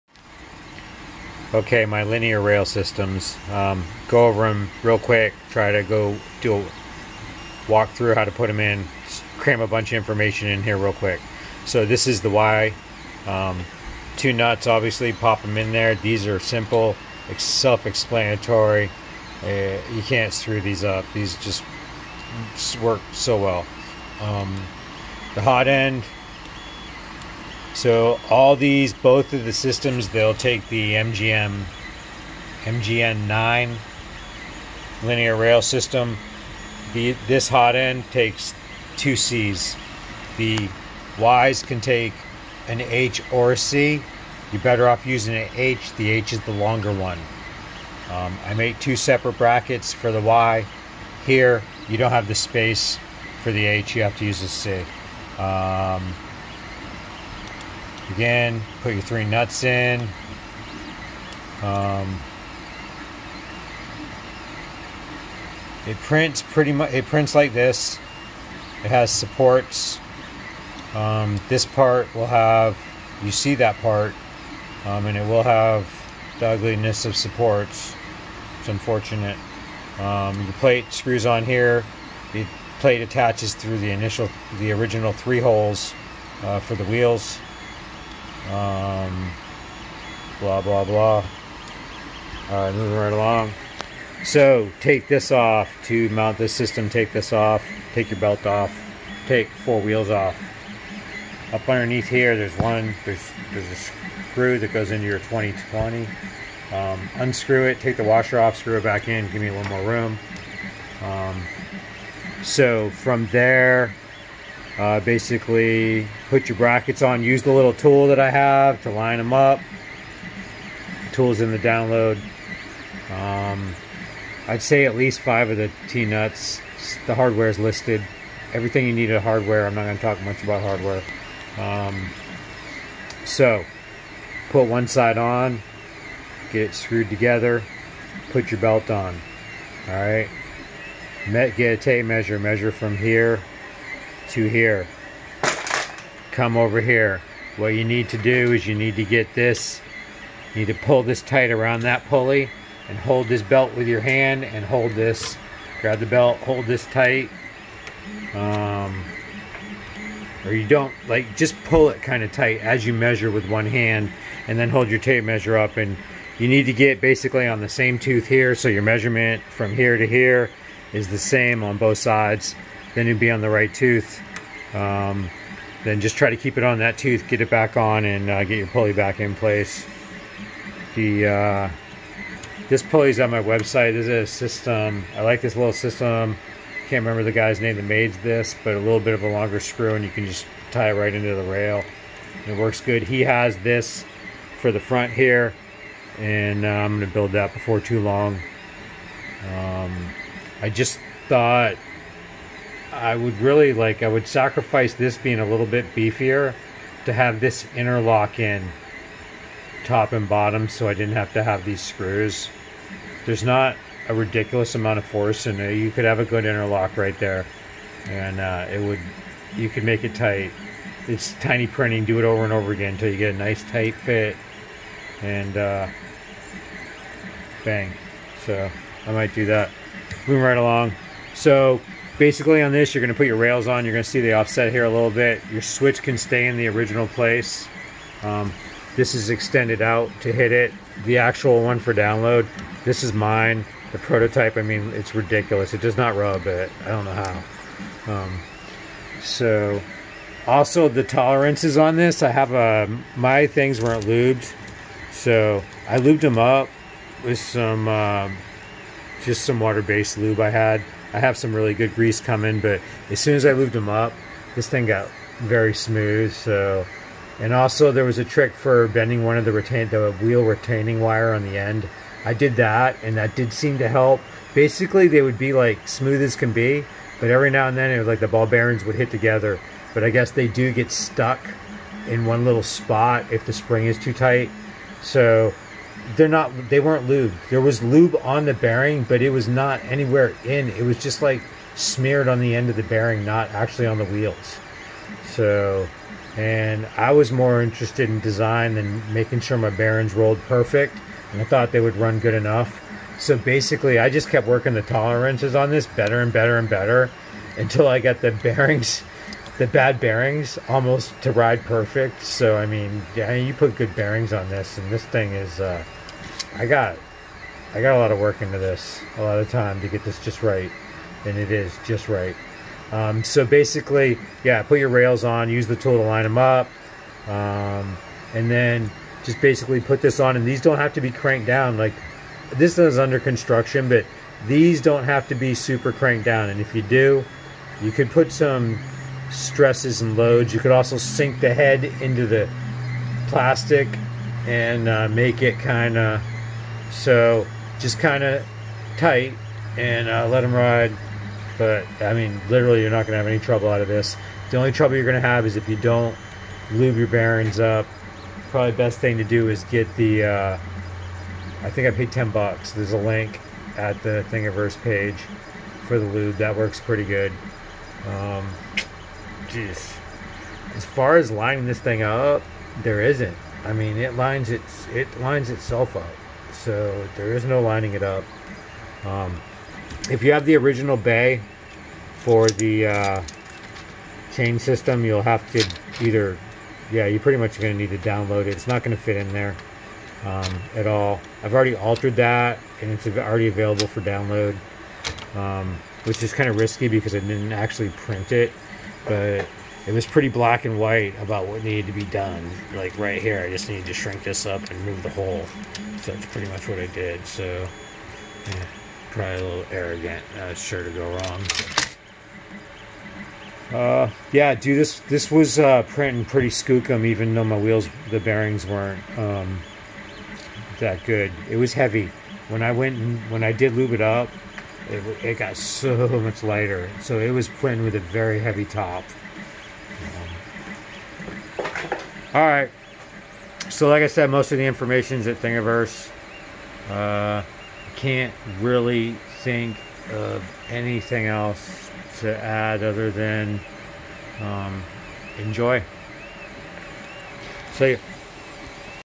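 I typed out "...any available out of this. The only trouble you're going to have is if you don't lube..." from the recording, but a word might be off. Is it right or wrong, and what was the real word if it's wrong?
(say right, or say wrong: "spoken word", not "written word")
wrong: "trouble", not "available".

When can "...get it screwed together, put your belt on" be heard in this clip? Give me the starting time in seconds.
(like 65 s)
136 s.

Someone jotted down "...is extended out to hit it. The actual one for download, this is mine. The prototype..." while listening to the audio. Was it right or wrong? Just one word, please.
right.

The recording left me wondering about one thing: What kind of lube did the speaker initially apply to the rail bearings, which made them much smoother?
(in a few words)
water-based lube.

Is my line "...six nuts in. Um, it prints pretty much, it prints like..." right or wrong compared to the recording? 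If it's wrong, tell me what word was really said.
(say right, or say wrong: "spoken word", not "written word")
wrong: "three", not "six".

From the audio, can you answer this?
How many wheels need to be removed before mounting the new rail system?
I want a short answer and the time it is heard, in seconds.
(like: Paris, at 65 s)
4, at 99 s.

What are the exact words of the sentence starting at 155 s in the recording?
Grab the belt, hold this tight.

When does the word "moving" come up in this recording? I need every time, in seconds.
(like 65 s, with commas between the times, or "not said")
92 s, 230 s.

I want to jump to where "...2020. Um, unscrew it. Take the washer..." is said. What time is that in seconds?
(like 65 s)
105 s.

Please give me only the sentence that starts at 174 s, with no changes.
Um, then just try to keep it on that tooth, get it back on, and uh, get your pulley back in place.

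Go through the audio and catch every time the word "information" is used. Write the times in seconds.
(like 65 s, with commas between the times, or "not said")
9 s, 434 s.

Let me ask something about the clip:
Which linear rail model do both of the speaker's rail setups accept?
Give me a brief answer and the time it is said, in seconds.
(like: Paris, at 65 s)
MGN9, at 32 s.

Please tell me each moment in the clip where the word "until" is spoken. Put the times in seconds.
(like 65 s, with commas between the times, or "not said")
222 s, 307 s.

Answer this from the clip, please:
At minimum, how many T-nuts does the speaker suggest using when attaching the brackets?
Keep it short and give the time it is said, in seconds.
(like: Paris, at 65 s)
5, at 124 s.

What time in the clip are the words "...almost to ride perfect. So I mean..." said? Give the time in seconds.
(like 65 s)
310 s.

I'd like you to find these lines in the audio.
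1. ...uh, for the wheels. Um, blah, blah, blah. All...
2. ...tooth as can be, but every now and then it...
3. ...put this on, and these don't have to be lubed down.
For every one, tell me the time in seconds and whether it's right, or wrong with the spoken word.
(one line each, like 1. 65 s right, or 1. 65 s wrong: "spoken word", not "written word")
1. 86 s right
2. 275 s wrong: "smooth", not "tooth"
3. 329 s wrong: "cranked", not "lubed".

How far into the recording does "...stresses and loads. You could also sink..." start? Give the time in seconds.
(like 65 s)
339 s.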